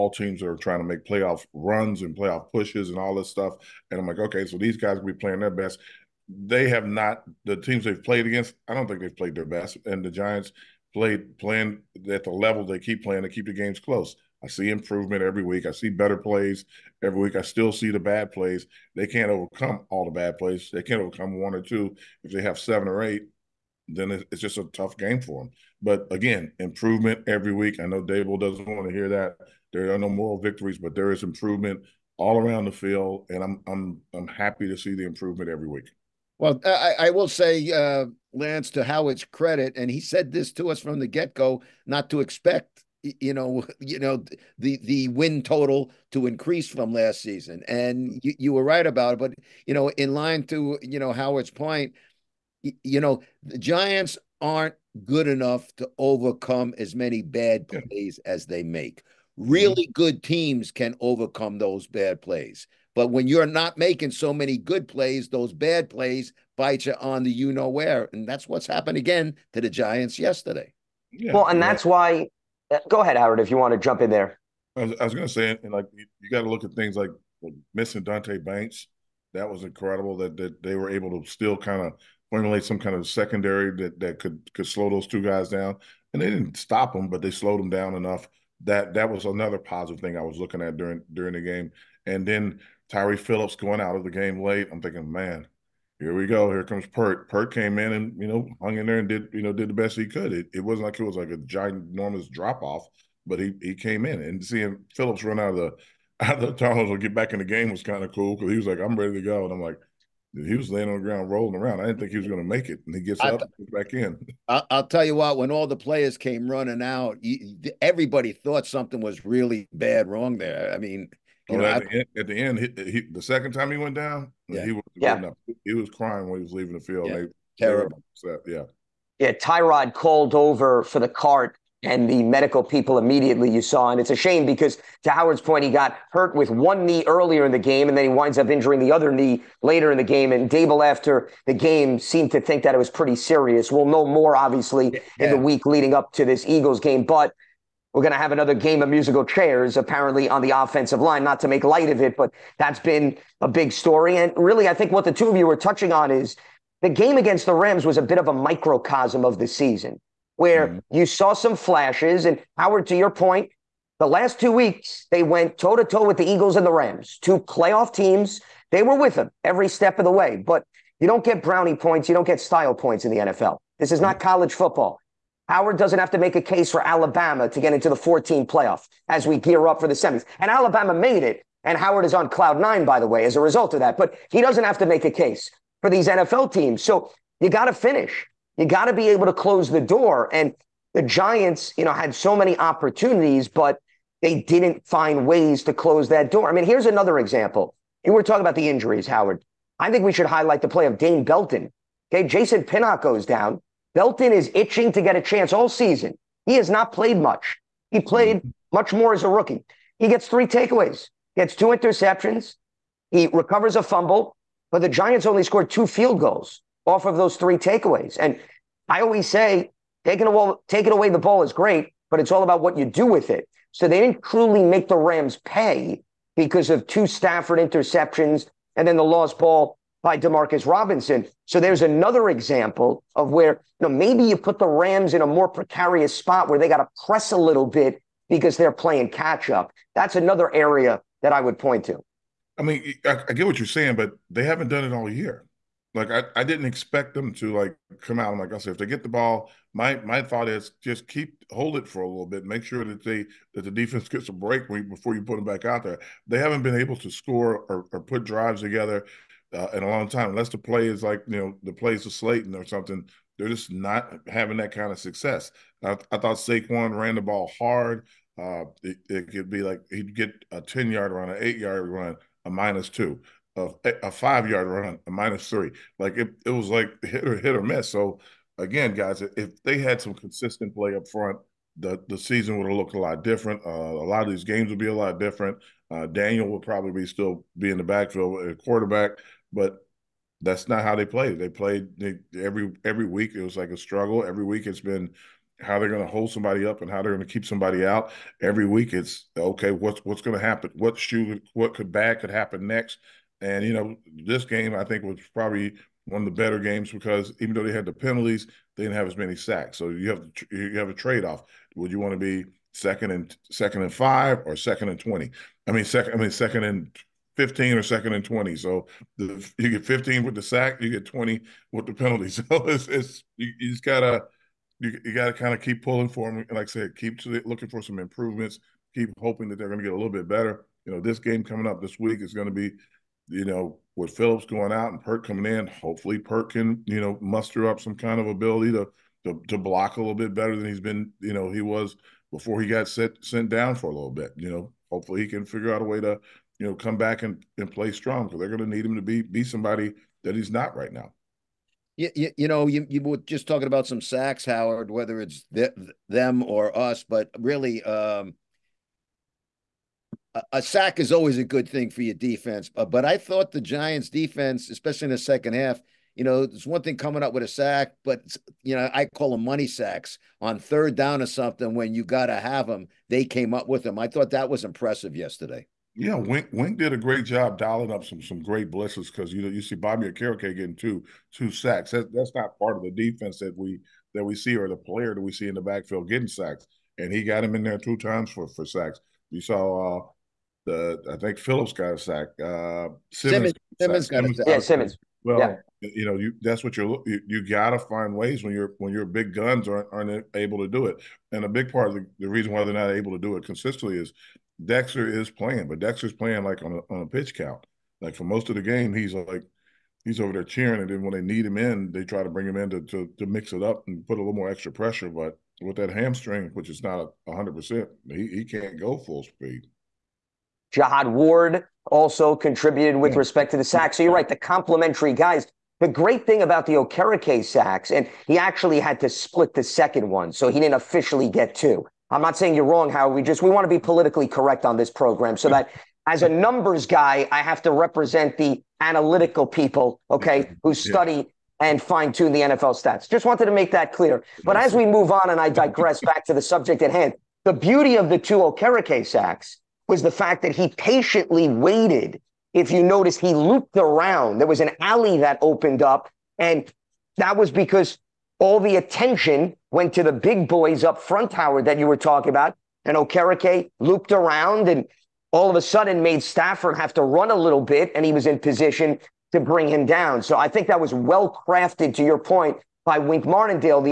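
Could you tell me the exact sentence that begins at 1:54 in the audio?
I, will tell you what: when all the players came running out, everybody thought something was really bad wrong there.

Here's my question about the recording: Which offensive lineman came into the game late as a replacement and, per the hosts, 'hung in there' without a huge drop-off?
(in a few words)
Pert.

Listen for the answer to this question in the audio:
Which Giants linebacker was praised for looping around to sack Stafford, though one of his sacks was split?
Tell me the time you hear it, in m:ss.
6:19.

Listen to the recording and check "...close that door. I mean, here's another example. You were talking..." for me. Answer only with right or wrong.
right.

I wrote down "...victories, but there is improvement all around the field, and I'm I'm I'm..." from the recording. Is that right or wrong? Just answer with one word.
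right.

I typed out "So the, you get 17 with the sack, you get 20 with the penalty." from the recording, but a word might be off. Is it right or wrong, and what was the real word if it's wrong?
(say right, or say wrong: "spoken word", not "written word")
wrong: "15", not "17".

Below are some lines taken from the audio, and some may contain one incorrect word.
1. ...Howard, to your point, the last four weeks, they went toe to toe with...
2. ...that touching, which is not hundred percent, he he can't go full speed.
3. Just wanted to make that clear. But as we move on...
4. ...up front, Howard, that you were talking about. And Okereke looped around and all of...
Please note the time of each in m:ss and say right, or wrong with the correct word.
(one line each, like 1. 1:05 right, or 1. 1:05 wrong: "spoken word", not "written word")
1. 2:42 wrong: "two", not "four"
2. 6:55 wrong: "hamstring", not "touching"
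3. 7:23 right
4. 7:40 right.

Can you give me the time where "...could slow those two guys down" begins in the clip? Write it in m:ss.
1:24.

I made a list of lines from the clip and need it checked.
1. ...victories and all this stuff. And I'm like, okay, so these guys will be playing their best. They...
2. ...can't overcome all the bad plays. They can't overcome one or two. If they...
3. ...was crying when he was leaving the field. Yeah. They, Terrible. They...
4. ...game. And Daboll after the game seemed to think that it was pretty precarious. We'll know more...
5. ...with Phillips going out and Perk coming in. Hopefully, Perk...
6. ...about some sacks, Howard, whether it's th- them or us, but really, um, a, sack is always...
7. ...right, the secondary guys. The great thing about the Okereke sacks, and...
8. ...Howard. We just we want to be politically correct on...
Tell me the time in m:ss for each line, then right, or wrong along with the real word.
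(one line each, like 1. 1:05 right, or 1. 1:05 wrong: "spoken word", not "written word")
1. 0:02 wrong: "pushes", not "victories"
2. 0:19 right
3. 2:05 right
4. 2:20 wrong: "serious", not "precarious"
5. 5:33 right
6. 5:53 right
7. 7:04 wrong: "complimentary", not "secondary"
8. 7:12 right.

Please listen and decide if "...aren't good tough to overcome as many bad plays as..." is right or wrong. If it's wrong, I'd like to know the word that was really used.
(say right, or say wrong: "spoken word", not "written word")
wrong: "enough", not "tough".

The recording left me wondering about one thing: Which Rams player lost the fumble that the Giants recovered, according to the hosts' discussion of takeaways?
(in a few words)
Demarcus Robinson.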